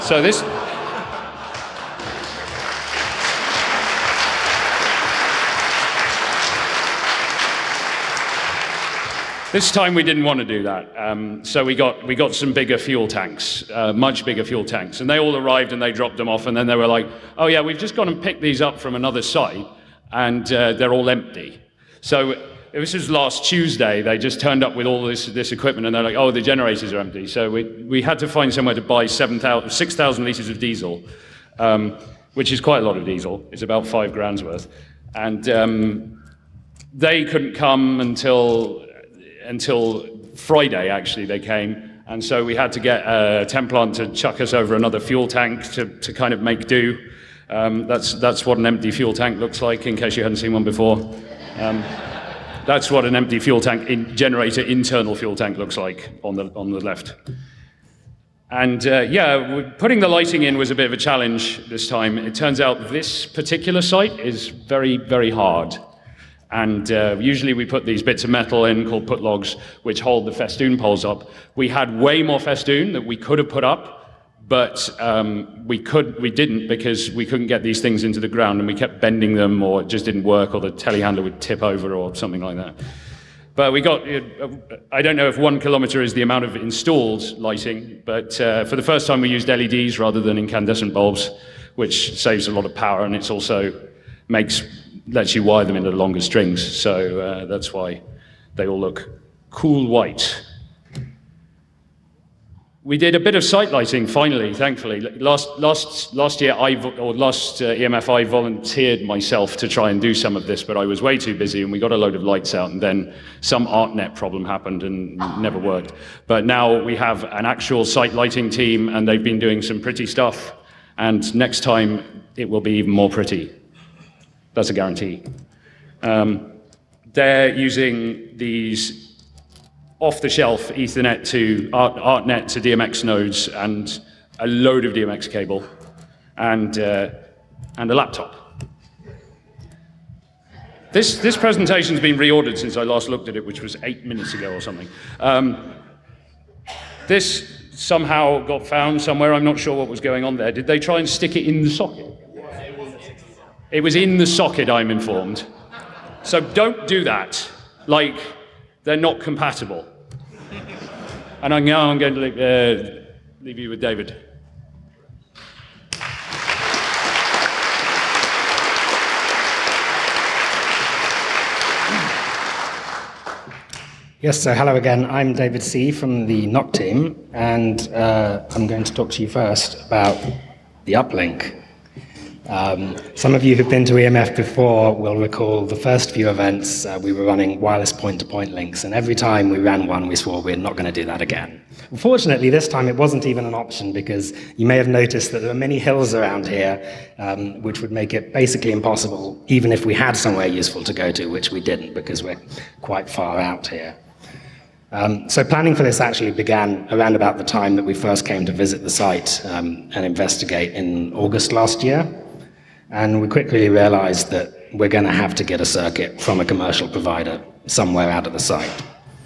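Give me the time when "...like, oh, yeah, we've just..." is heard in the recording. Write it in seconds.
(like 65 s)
16 s.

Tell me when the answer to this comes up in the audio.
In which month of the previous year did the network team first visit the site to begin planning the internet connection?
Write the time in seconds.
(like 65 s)
211 s.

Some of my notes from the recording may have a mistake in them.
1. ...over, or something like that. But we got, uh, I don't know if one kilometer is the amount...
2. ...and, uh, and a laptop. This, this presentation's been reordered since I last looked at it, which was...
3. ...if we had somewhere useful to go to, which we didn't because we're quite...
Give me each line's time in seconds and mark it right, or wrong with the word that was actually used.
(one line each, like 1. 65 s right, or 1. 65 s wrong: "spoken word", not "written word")
1. 81 s right
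2. 136 s right
3. 199 s right.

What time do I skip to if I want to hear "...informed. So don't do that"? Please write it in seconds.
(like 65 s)
154 s.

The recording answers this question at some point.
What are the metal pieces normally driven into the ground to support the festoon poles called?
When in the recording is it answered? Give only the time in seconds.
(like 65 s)
69 s.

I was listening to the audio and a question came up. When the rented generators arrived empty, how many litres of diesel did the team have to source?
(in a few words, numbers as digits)
6,000 litres.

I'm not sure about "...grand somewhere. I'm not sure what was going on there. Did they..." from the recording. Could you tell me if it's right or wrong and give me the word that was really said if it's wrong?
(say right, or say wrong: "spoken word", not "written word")
wrong: "found", not "grand".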